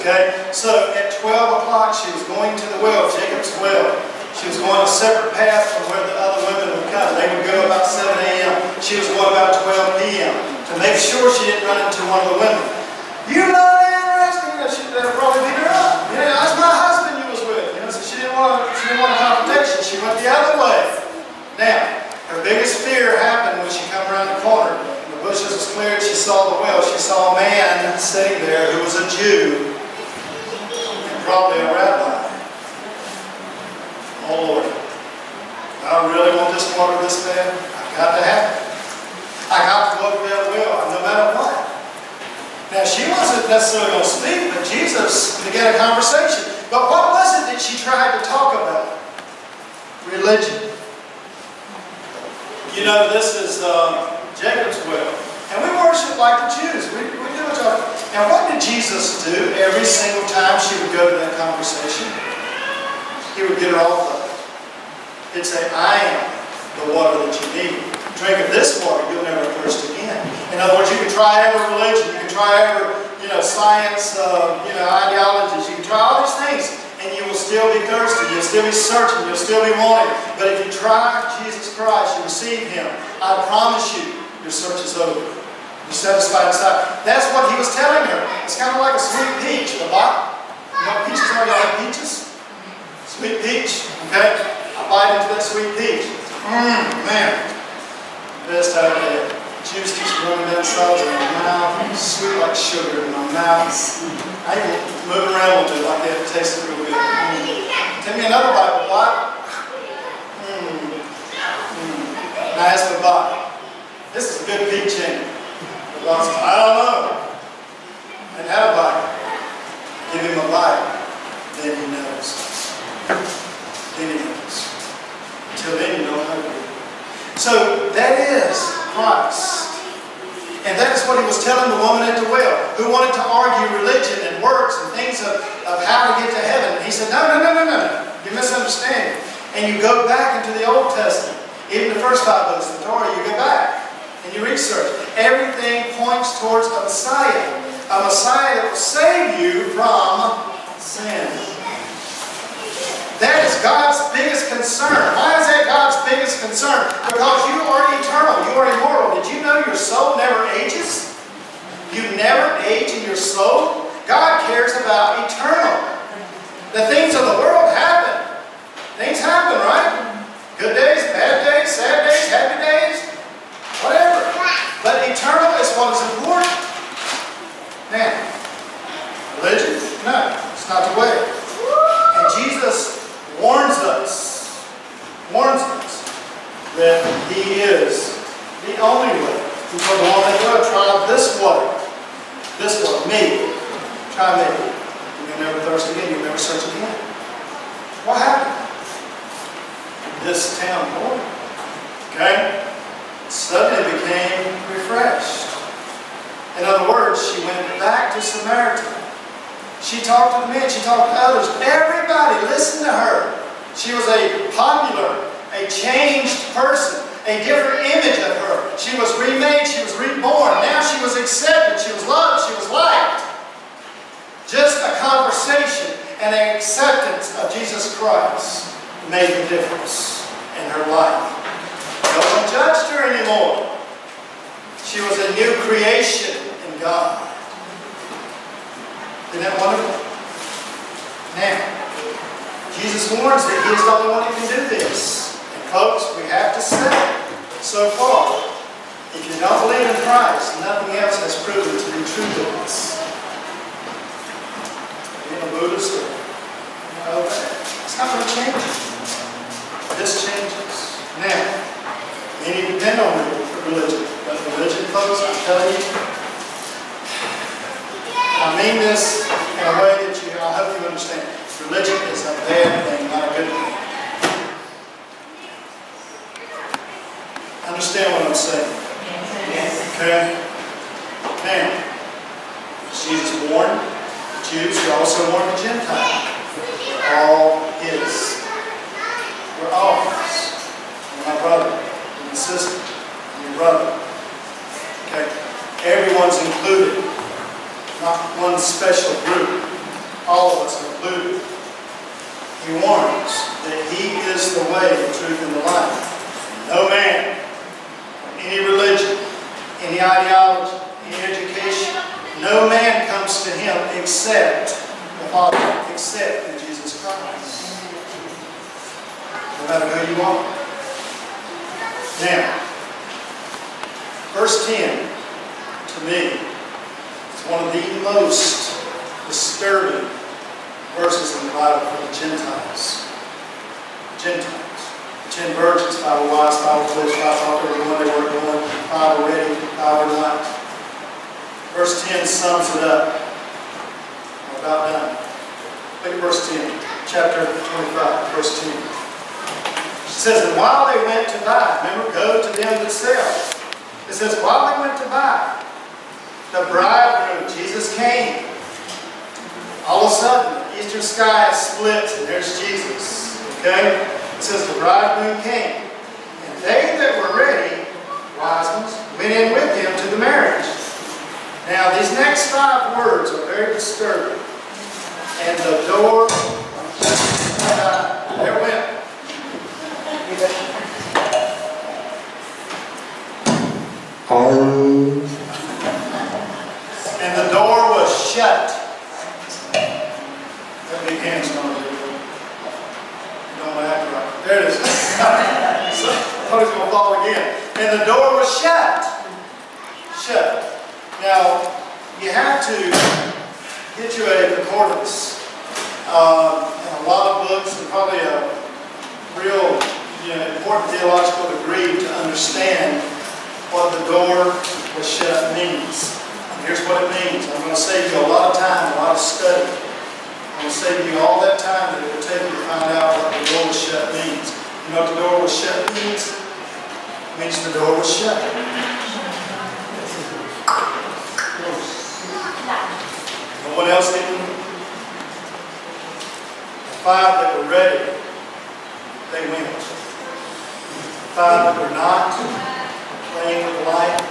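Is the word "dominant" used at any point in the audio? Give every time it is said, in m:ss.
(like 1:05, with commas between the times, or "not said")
not said.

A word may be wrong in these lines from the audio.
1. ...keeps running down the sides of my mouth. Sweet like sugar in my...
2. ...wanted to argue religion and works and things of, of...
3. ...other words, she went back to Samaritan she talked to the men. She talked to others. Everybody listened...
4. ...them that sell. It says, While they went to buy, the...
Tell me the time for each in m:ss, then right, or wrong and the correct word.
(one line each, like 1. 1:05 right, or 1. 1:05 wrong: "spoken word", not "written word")
1. 1:39 right
2. 2:12 right
3. 3:26 right
4. 5:52 right.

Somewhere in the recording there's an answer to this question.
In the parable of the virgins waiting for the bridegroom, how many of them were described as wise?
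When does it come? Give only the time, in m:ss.
5:35.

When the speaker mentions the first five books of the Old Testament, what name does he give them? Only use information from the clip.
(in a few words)
Torah.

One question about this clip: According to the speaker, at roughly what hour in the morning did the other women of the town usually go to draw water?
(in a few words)
7 a.m.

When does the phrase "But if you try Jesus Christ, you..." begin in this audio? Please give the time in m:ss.
1:20.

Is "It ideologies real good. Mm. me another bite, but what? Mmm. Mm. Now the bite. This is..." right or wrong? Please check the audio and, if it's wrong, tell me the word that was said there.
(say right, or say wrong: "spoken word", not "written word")
wrong: "tastes", not "ideologies".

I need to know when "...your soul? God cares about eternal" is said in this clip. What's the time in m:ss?
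2:43.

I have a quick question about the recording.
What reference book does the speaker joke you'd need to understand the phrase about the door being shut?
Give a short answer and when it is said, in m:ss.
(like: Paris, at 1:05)
Concordance, at 6:44.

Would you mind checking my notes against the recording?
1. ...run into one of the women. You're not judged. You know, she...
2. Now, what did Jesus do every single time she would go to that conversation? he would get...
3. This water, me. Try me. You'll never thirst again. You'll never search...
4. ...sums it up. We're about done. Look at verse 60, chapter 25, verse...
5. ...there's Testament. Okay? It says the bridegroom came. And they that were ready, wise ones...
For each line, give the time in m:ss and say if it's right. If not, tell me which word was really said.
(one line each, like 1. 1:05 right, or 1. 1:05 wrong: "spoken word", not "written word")
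1. 0:11 wrong: "interested", not "judged"
2. 0:58 right
3. 3:12 right
4. 5:42 wrong: "10", not "60"
5. 6:02 wrong: "Jesus", not "Testament".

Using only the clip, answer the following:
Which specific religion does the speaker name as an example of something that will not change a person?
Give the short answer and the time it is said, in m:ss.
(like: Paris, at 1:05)
Buddhist, at 4:15.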